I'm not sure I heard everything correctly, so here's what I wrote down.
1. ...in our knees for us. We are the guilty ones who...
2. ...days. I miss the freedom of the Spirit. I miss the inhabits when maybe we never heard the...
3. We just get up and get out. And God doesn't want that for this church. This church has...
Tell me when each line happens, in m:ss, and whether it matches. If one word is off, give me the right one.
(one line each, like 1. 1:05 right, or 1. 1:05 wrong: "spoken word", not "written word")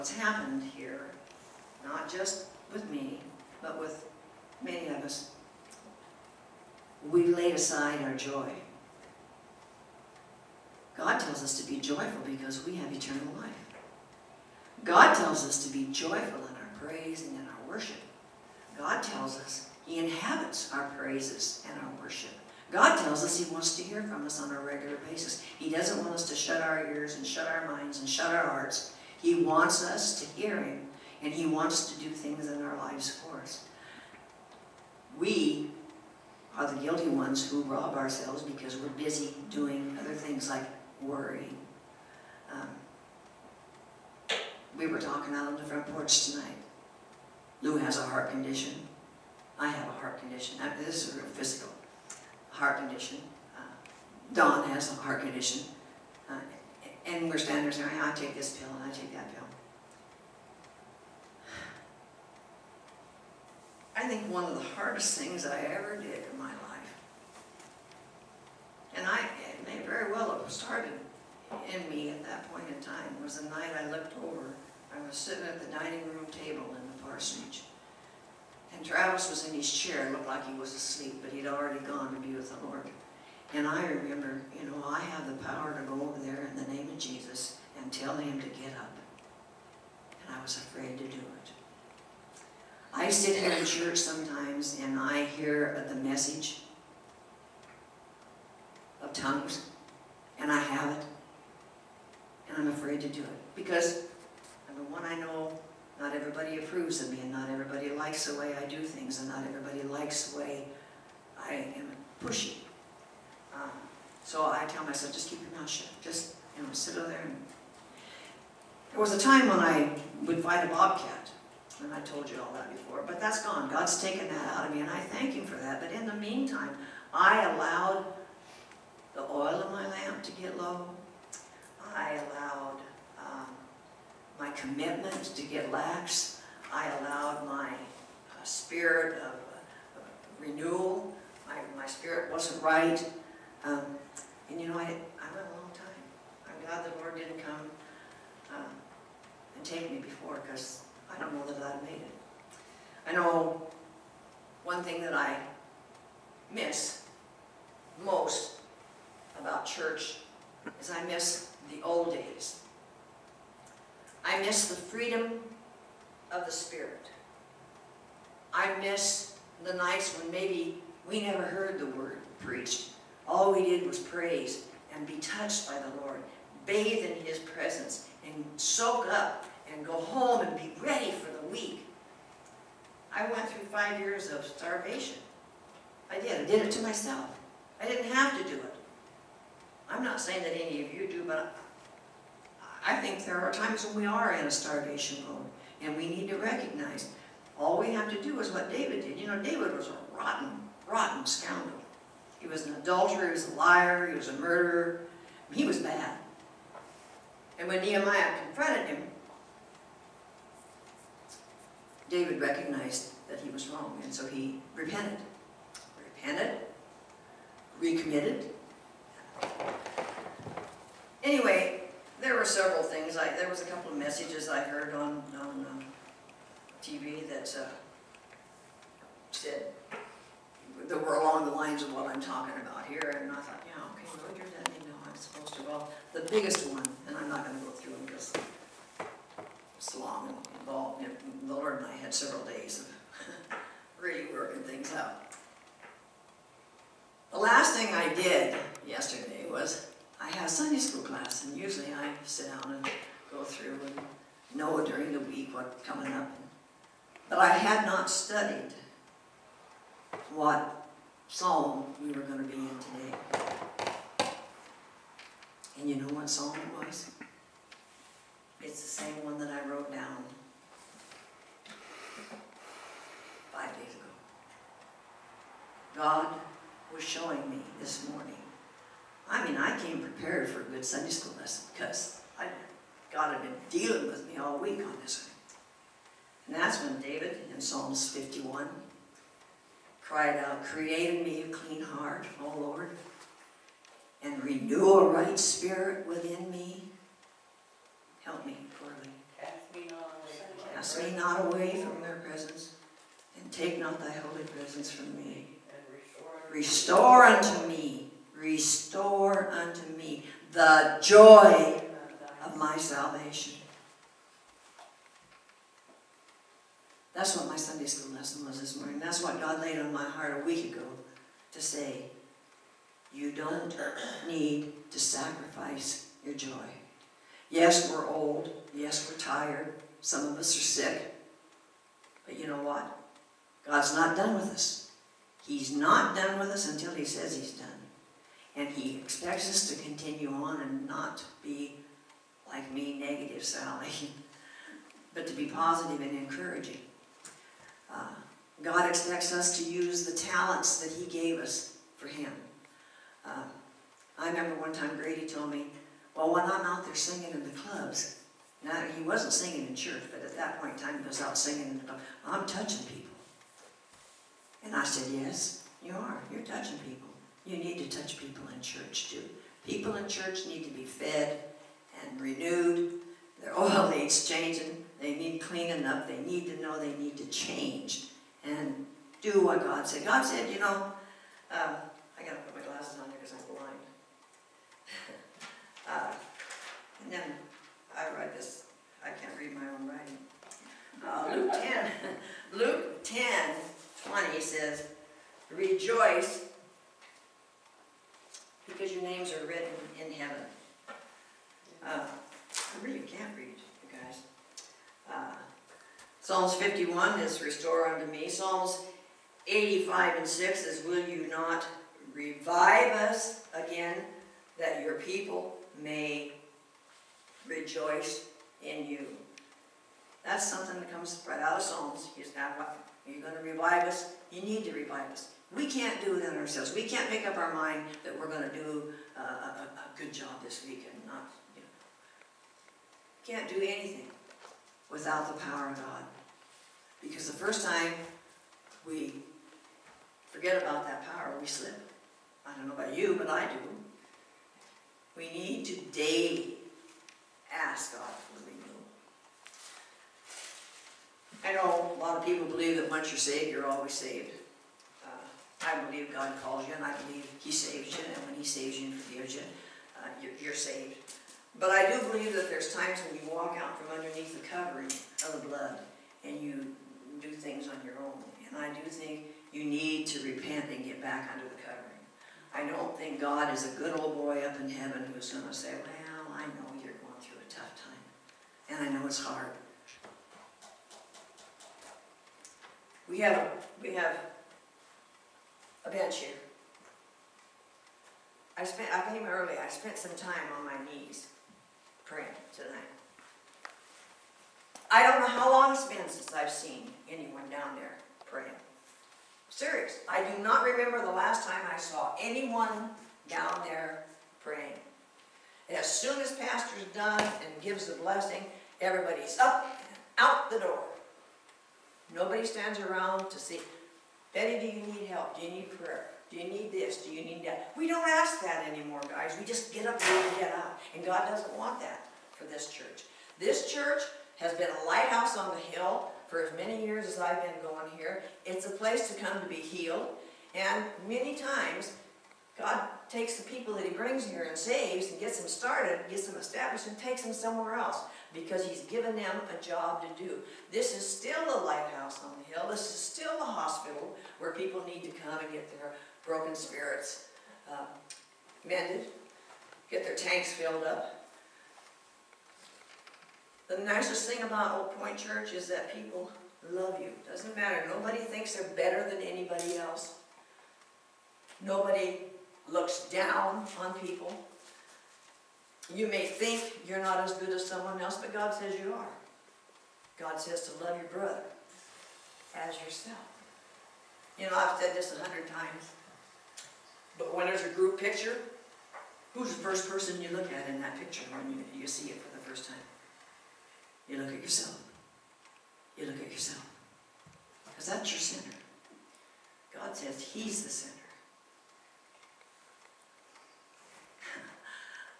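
1. 0:32 wrong: "lives", not "knees"
2. 2:42 wrong: "nights", not "inhabits"
3. 8:39 right.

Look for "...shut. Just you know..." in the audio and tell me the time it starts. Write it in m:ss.
1:55.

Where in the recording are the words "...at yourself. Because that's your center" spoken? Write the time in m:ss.
9:46.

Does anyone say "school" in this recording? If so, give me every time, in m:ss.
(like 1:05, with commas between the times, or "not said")
4:10, 4:41, 5:17.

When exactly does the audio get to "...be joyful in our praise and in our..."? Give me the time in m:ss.
0:15.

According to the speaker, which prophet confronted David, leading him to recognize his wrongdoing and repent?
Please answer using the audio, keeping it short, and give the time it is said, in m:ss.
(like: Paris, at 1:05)
Nehemiah, at 3:27.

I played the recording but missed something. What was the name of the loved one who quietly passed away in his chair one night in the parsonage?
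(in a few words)
Travis.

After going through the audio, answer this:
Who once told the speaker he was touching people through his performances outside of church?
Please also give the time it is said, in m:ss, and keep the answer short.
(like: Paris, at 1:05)
Grady, at 5:54.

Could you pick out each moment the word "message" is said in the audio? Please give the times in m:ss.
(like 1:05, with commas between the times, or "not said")
1:35, 3:43.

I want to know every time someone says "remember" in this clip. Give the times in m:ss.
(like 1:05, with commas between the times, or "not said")
1:23, 5:54, 8:20.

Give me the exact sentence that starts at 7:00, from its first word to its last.
That's something that comes right out of Psalms.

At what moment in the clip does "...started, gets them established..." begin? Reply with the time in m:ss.
8:55.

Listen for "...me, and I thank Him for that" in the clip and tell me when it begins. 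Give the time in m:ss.
2:04.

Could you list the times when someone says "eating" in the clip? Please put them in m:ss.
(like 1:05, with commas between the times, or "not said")
not said.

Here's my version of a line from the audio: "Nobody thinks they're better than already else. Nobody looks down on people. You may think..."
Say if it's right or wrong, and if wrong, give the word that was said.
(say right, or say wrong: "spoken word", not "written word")
wrong: "anybody", not "already".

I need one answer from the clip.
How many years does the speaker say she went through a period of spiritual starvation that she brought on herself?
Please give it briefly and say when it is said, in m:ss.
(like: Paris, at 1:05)
5, at 3:03.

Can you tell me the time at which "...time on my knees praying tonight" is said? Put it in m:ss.
8:10.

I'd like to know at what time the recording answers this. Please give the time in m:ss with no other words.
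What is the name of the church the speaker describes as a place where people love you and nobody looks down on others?
9:14.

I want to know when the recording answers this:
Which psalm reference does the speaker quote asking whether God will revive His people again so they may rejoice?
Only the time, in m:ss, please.
6:48.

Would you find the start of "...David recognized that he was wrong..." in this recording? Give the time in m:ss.
3:32.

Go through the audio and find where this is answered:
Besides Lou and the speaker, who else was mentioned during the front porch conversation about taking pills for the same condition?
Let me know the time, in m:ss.
0:54.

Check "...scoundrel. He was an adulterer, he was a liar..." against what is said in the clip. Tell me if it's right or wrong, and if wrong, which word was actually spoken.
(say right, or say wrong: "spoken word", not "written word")
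right.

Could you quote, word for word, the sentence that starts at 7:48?
And I do think you need to repent and get back under the covering.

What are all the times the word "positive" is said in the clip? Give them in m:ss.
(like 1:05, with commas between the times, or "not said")
5:45.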